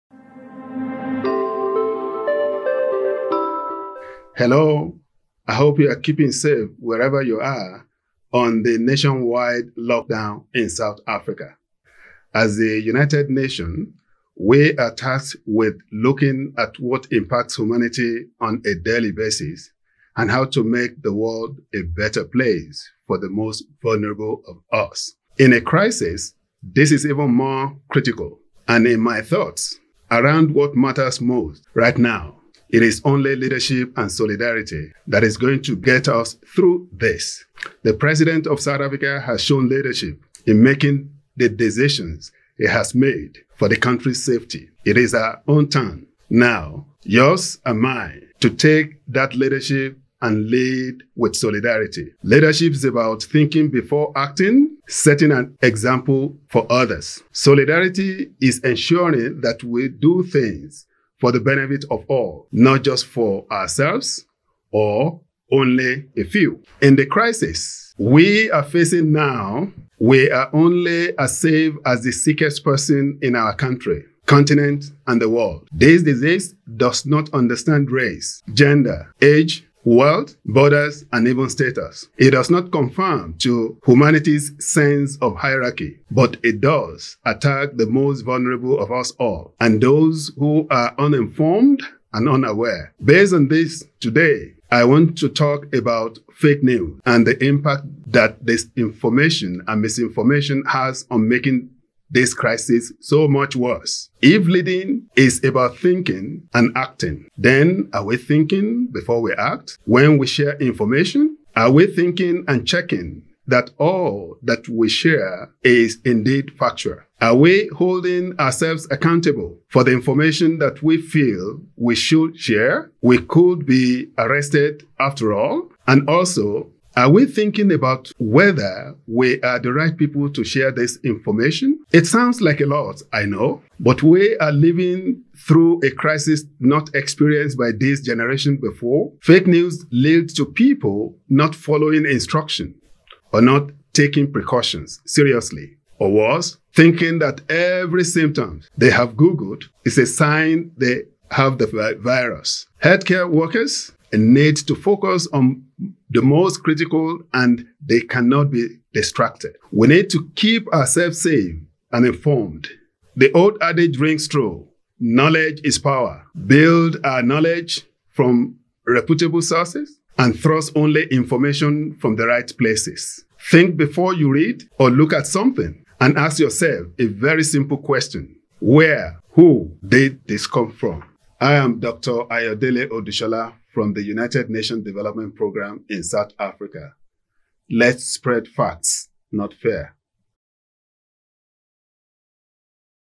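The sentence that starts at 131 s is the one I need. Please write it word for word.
It sounds like a lot, I know, but we are living through a crisis not experienced by this generation before.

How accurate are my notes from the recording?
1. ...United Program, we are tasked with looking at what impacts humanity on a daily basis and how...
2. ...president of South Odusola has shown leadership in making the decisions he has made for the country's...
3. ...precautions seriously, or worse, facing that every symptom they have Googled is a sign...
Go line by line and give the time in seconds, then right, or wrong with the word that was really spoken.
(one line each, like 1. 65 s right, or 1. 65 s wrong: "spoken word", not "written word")
1. 12 s wrong: "Nations", not "Program"
2. 37 s wrong: "Africa", not "Odusola"
3. 144 s wrong: "thinking", not "facing".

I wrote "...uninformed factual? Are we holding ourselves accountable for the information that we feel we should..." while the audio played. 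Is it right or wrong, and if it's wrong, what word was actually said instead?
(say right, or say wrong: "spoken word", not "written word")
wrong: "indeed", not "uninformed".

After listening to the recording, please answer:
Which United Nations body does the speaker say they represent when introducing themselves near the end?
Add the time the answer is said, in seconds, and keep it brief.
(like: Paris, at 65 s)
United Nations Development Program, at 184 s.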